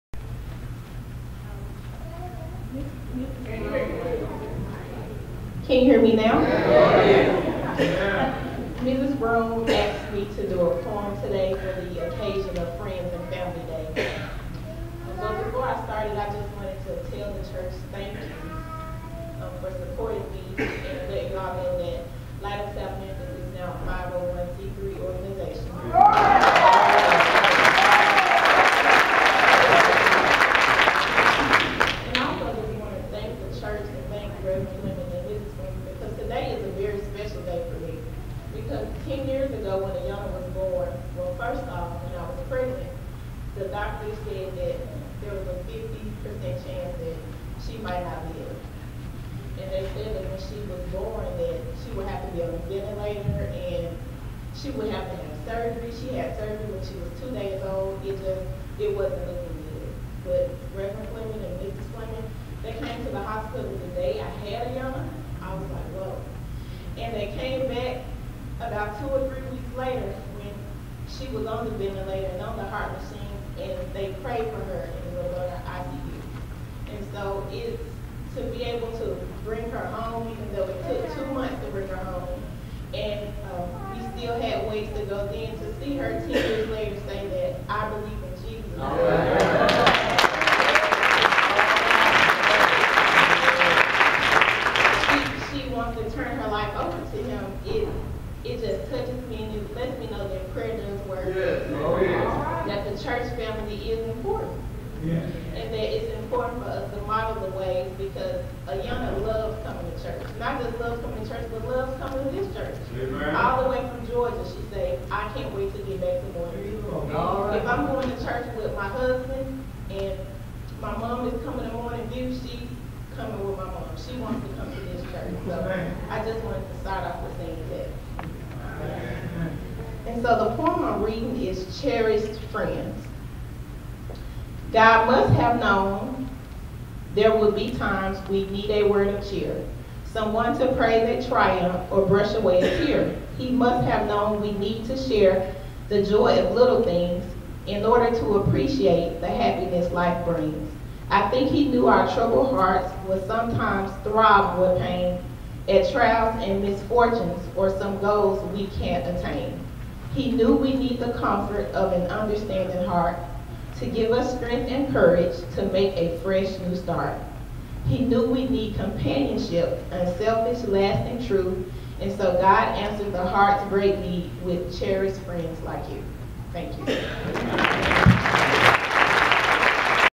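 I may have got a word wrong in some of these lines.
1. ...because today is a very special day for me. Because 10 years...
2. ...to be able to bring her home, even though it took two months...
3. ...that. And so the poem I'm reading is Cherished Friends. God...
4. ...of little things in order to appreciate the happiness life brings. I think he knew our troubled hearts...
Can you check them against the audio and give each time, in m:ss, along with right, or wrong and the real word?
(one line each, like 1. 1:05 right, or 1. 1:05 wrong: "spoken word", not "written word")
1. 0:35 right
2. 1:18 right
3. 2:07 right
4. 2:26 right.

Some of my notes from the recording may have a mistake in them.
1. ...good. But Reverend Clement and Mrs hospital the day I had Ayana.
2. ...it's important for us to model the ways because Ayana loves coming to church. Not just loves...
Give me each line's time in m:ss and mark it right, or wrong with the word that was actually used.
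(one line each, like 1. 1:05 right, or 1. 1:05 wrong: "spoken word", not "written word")
1. 0:59 right
2. 1:45 right.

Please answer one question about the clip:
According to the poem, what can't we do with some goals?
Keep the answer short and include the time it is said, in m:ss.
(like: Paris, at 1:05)
attain, at 2:39.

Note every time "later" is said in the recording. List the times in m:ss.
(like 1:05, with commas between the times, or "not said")
1:09, 1:26.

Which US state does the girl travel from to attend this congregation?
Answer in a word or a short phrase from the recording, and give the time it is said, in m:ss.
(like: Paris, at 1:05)
Georgia, at 1:54.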